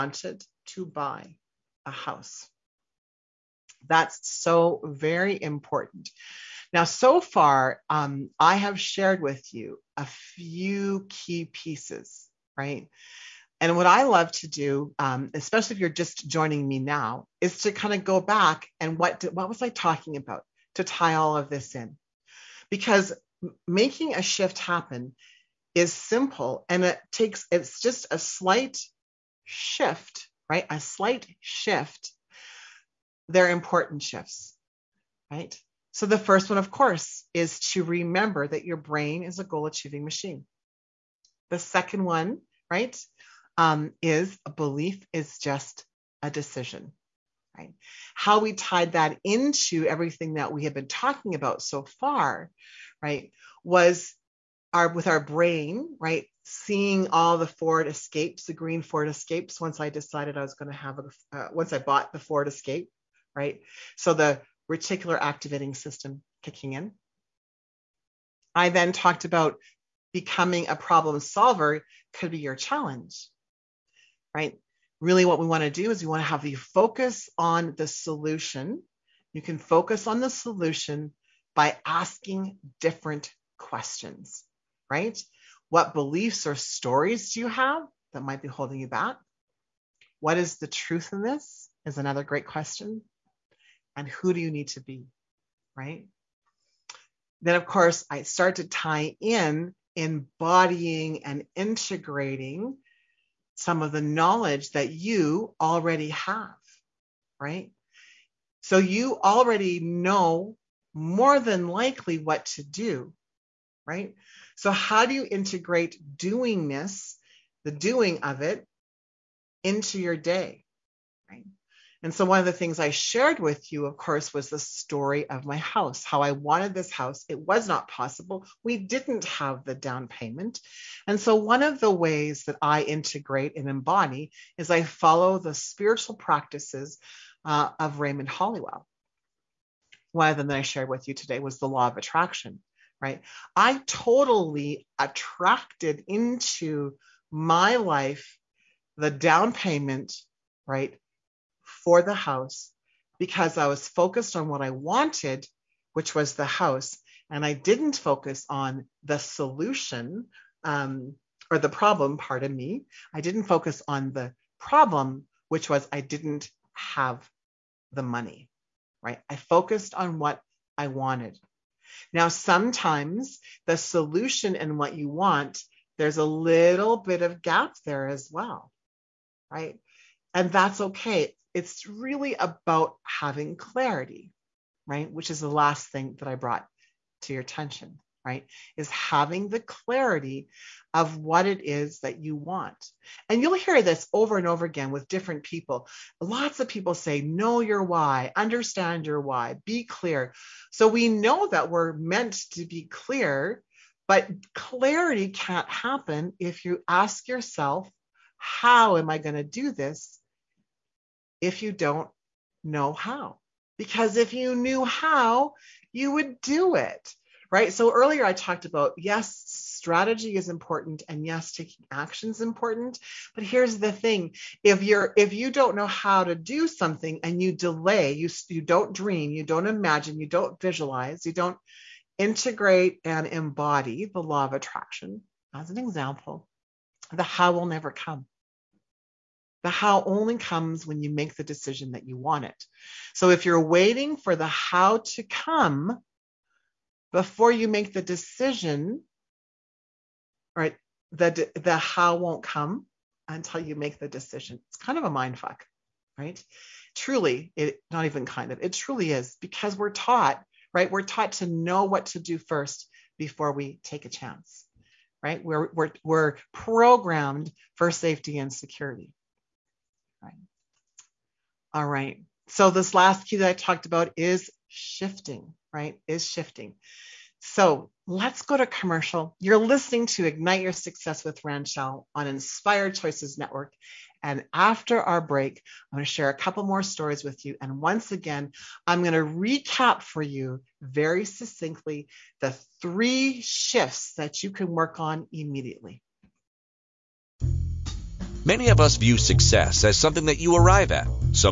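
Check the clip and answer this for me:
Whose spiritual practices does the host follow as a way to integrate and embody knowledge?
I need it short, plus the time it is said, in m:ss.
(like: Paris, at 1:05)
Raymond Holliwell, at 2:17.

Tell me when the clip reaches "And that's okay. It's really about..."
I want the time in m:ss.
3:00.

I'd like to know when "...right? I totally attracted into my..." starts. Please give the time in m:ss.
2:23.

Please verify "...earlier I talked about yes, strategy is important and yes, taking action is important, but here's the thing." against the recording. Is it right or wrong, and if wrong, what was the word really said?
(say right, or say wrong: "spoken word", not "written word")
right.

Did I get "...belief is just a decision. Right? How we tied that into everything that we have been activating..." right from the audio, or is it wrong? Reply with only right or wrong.
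wrong.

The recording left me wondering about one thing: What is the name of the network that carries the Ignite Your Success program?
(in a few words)
Inspired Choices Network.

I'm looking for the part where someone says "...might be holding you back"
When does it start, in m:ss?
1:28.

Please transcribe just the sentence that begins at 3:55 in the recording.
As an example, the how will never come.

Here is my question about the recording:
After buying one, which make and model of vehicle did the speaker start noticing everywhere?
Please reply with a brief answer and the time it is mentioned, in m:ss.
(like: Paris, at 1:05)
Ford Escape, at 1:02.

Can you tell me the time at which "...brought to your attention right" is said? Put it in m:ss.
3:06.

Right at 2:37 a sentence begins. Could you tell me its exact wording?
And I didn't focus on the solution, um, or the problem, pardon me.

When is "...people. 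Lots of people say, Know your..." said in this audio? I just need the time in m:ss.
3:15.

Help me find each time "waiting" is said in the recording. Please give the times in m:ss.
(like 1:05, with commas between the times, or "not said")
4:03.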